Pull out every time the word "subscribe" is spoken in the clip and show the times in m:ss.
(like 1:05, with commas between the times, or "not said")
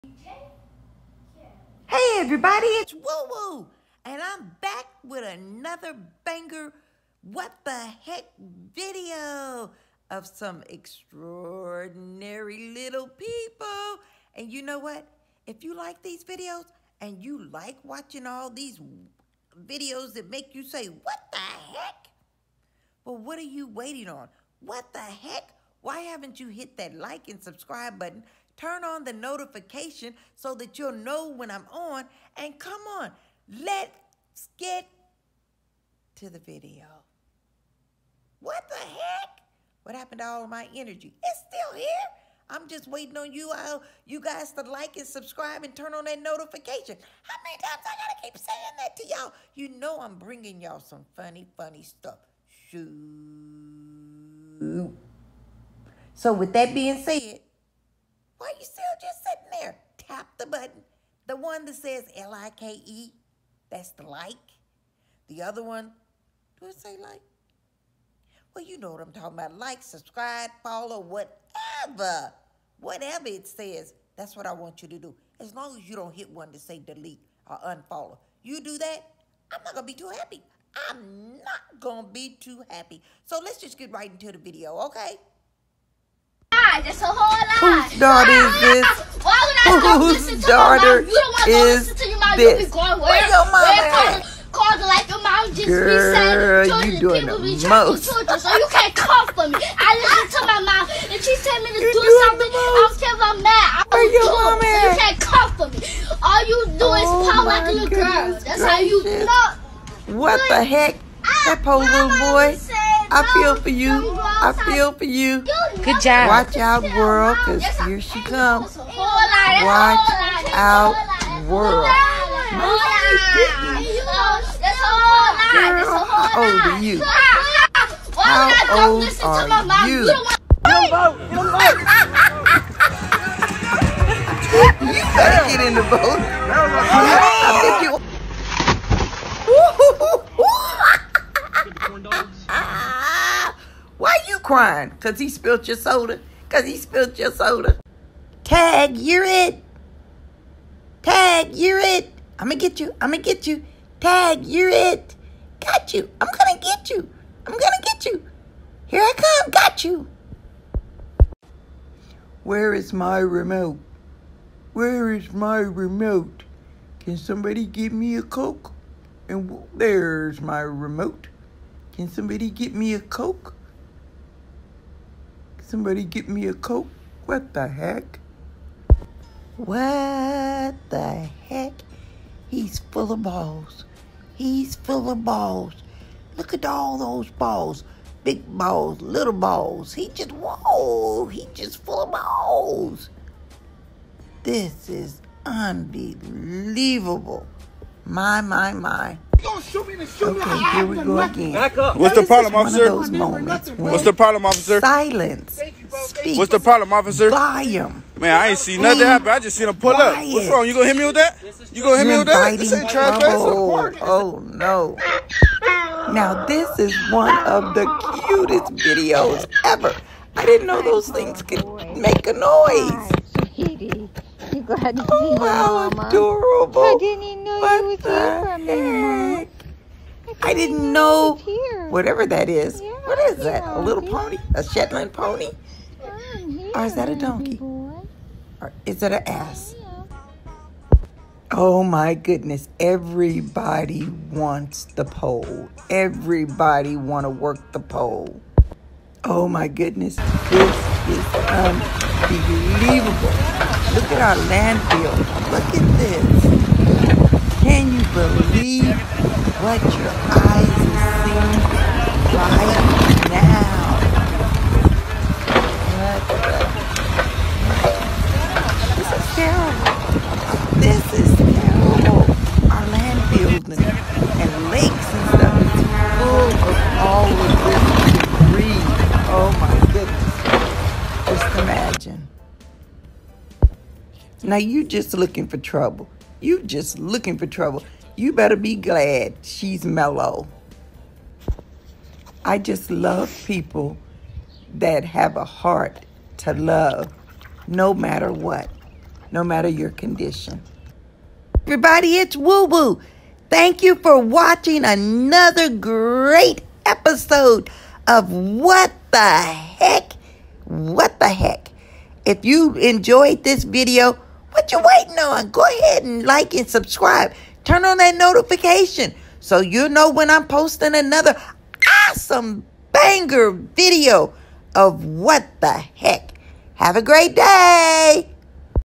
0:27, 0:45, 1:09, 5:16.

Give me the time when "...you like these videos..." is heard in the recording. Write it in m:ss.
0:15.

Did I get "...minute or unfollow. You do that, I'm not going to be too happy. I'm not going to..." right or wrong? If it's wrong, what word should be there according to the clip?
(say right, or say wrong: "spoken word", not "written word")
wrong: "delete", not "minute".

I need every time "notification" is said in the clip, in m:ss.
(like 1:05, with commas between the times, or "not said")
0:29, 0:46, 5:18.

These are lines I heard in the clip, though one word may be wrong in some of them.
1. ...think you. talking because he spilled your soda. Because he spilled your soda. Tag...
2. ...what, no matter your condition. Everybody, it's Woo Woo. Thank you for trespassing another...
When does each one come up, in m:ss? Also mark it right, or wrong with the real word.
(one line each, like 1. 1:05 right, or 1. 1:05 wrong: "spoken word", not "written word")
1. 2:17 wrong: "crying", not "talking"
2. 4:58 wrong: "watching", not "trespassing".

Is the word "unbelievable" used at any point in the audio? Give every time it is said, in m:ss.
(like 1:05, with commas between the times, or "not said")
3:15, 4:11.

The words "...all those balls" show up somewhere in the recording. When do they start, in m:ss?
3:06.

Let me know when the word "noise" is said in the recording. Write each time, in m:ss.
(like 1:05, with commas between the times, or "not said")
3:42.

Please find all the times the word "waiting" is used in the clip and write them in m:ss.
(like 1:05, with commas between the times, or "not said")
0:23, 0:42, 5:14.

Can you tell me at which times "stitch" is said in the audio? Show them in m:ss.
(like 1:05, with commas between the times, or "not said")
not said.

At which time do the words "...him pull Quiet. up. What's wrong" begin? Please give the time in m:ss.
3:29.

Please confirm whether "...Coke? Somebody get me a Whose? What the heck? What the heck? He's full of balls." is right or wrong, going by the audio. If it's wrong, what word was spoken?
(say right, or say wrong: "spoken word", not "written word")
wrong: "Coke", not "Whose".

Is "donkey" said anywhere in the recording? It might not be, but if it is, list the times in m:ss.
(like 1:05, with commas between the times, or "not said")
3:57.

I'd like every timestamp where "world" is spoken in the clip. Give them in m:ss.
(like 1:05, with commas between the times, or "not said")
1:56, 2:01.